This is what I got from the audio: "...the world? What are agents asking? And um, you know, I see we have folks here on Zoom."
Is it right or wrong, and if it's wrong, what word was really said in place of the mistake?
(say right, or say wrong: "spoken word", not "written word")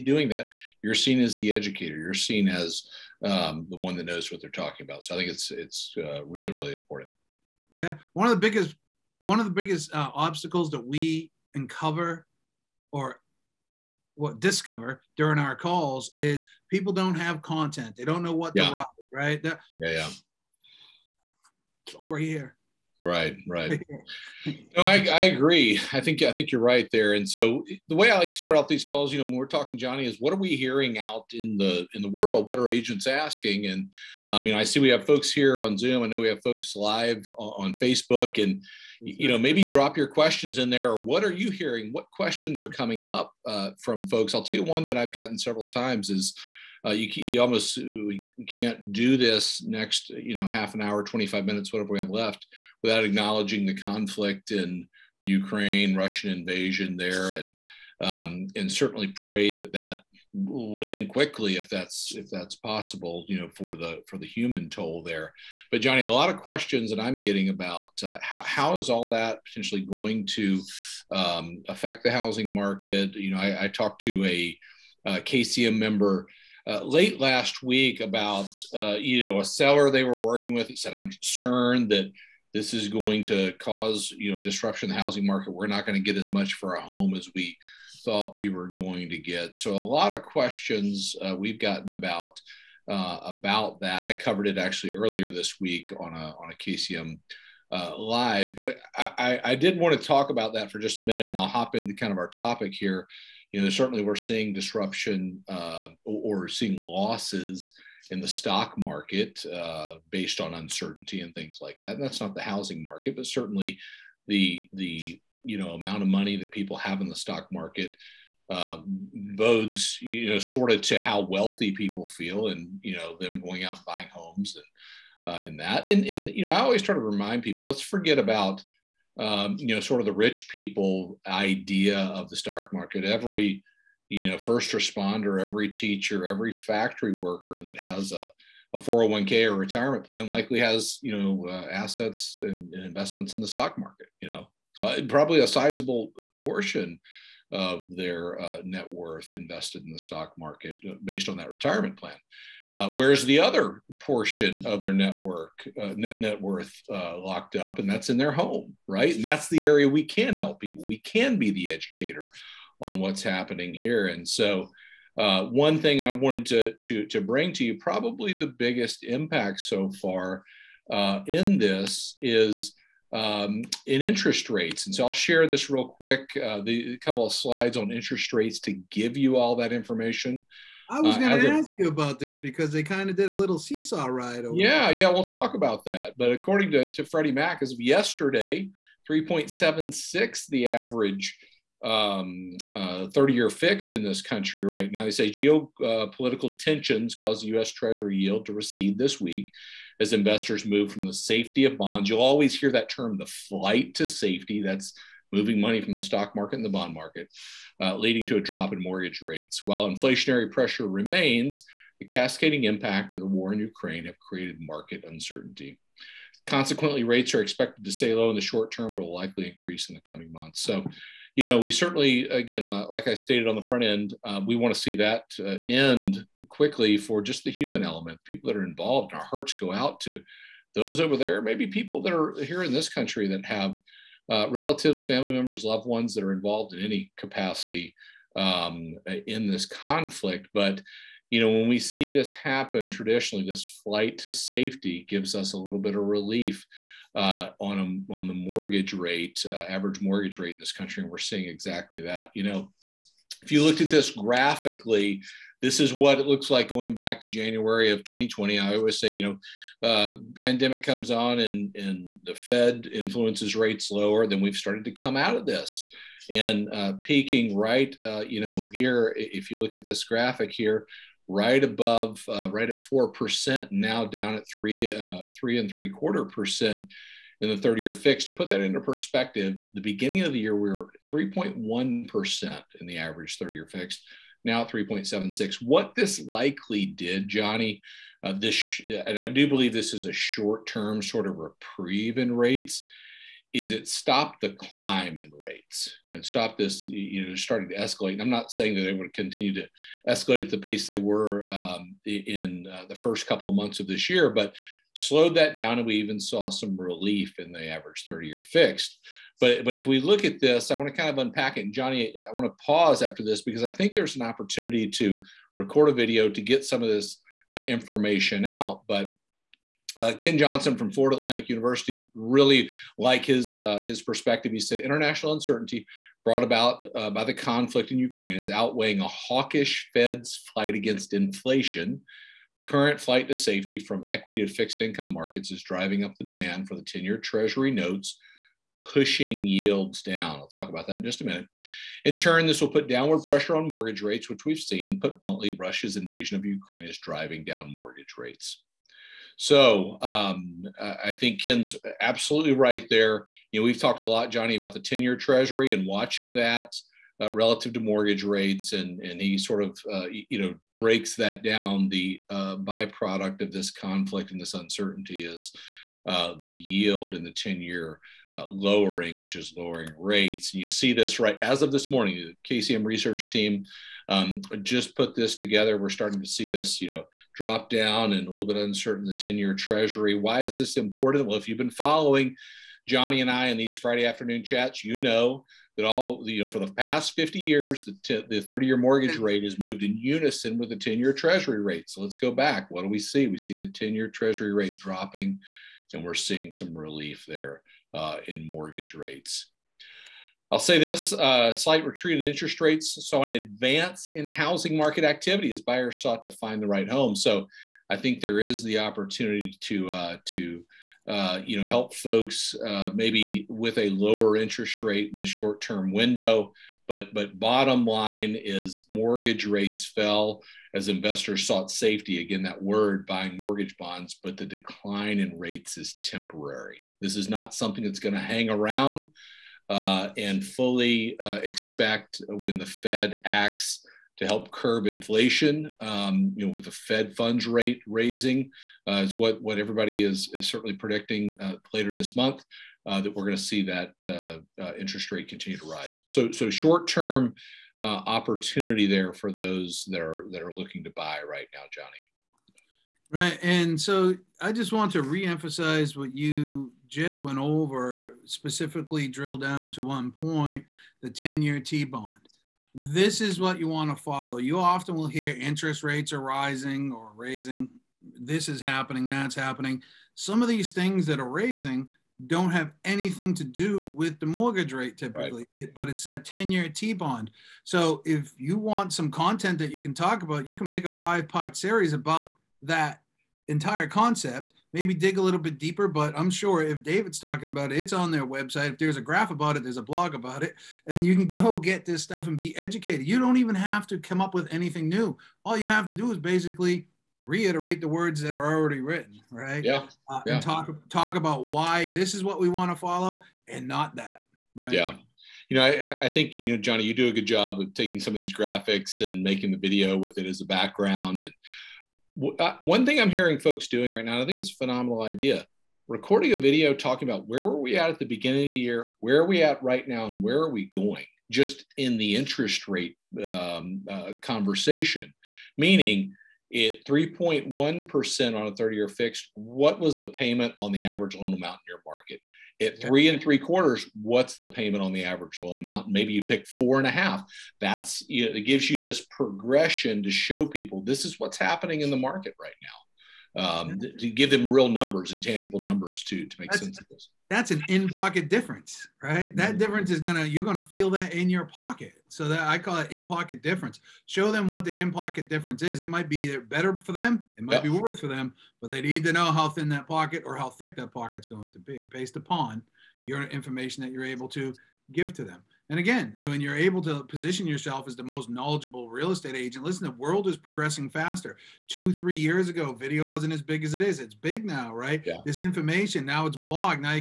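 right.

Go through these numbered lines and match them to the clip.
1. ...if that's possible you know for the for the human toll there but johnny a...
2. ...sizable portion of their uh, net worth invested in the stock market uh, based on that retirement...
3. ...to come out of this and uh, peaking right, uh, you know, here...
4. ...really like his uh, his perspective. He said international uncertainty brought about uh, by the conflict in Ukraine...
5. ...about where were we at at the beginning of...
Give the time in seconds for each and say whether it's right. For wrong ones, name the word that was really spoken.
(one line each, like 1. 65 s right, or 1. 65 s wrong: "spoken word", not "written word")
1. 62 s right
2. 145 s right
3. 264 s right
4. 322 s right
5. 517 s right.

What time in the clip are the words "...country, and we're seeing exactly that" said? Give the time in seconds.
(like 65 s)
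250 s.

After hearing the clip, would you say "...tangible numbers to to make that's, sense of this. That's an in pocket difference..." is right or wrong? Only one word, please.
right.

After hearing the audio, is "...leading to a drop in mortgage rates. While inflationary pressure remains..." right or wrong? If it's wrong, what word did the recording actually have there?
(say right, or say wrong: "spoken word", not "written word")
right.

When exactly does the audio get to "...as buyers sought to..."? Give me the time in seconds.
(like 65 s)
405 s.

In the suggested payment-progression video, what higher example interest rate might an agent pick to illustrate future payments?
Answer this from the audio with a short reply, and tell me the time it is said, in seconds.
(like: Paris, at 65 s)
4.5%, at 536 s.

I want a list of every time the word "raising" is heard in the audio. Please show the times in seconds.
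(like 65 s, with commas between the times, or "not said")
437 s, 467 s, 471 s.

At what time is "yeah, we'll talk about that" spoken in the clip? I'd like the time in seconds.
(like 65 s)
184 s.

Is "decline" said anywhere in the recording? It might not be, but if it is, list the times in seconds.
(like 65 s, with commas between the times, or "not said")
424 s.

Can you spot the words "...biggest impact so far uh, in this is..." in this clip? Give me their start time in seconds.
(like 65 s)
168 s.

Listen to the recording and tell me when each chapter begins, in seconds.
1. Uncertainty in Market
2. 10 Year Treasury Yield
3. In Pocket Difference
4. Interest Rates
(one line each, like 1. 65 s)
1. 30 s
2. 371 s
3. 553 s
4. 165 s.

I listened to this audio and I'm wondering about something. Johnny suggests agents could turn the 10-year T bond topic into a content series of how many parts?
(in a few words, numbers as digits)
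5.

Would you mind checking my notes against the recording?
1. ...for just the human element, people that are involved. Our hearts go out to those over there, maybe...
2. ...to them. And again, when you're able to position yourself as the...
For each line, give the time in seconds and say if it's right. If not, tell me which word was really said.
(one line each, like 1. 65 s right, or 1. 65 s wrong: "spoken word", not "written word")
1. 226 s right
2. 565 s right.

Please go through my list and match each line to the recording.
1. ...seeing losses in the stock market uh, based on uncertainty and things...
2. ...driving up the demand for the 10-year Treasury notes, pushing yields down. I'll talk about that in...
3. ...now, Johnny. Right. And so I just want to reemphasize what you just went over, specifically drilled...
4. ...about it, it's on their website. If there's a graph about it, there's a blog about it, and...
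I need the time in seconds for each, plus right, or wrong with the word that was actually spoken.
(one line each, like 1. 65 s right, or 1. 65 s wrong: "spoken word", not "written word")
1. 106 s right
2. 335 s right
3. 451 s right
4. 487 s right.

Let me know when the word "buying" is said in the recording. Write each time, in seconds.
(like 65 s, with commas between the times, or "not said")
123 s, 423 s.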